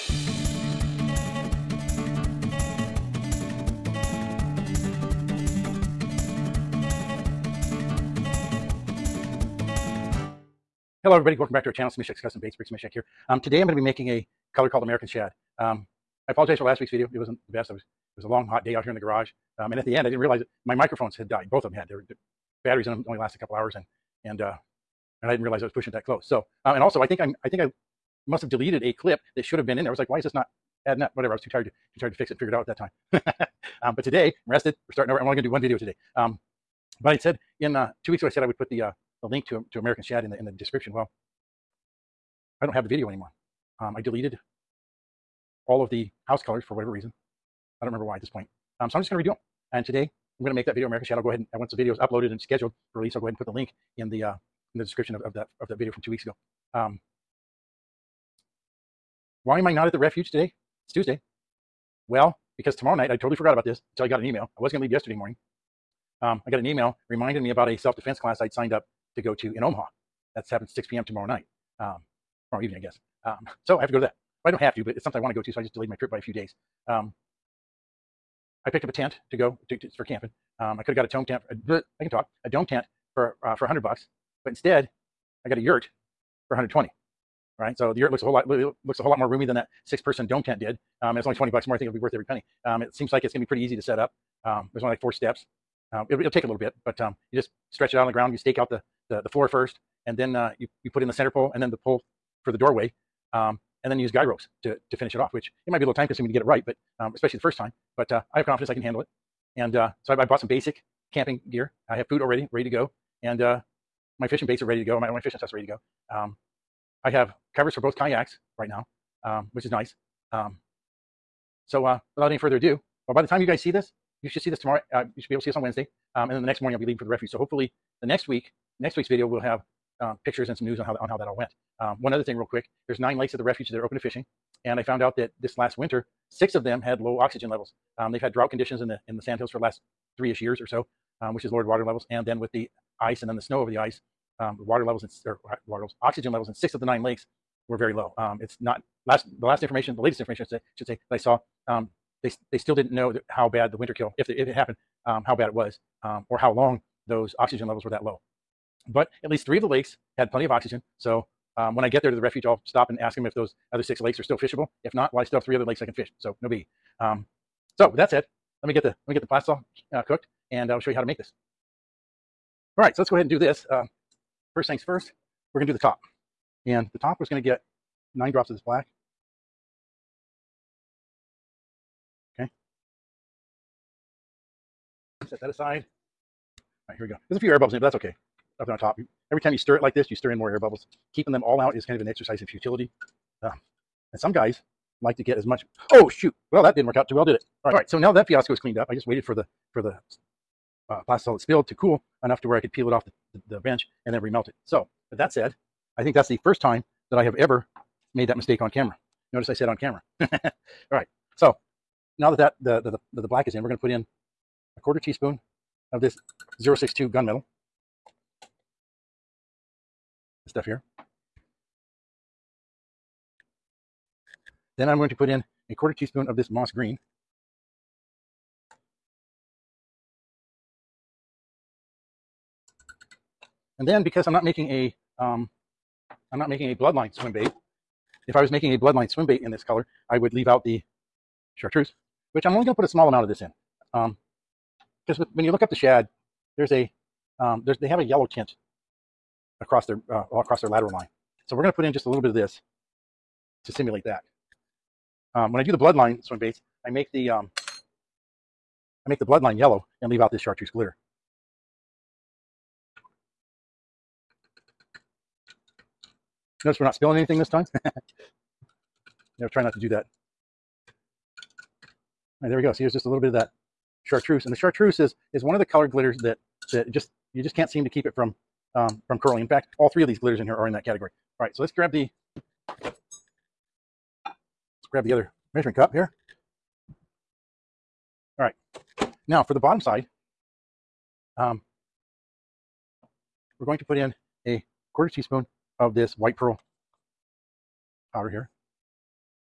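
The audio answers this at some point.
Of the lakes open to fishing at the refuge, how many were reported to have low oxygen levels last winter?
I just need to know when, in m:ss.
2:16.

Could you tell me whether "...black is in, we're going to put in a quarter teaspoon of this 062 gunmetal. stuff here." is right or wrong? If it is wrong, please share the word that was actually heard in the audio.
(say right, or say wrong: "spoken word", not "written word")
right.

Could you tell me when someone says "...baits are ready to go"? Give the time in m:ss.
1:54.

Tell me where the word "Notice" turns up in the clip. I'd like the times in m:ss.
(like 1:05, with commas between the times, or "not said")
3:29, 4:26.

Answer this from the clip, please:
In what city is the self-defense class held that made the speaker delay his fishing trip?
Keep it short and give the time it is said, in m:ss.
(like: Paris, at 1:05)
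Omaha, at 1:09.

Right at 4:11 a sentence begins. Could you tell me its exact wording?
So we're going to put in just a little bit of this to simulate that.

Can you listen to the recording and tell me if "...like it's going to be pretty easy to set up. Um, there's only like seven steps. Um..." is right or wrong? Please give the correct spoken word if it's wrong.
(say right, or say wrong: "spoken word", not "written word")
wrong: "four", not "seven".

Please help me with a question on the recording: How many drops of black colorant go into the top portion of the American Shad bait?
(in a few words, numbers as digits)
9.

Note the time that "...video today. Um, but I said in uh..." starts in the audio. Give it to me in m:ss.
0:35.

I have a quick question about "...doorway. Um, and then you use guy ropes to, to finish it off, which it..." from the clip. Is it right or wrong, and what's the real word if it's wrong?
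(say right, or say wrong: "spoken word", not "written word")
right.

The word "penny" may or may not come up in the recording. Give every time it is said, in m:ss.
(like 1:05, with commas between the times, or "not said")
1:32.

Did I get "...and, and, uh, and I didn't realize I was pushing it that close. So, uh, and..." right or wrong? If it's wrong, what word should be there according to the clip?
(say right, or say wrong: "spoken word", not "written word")
right.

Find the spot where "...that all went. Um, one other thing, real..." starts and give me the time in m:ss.
2:11.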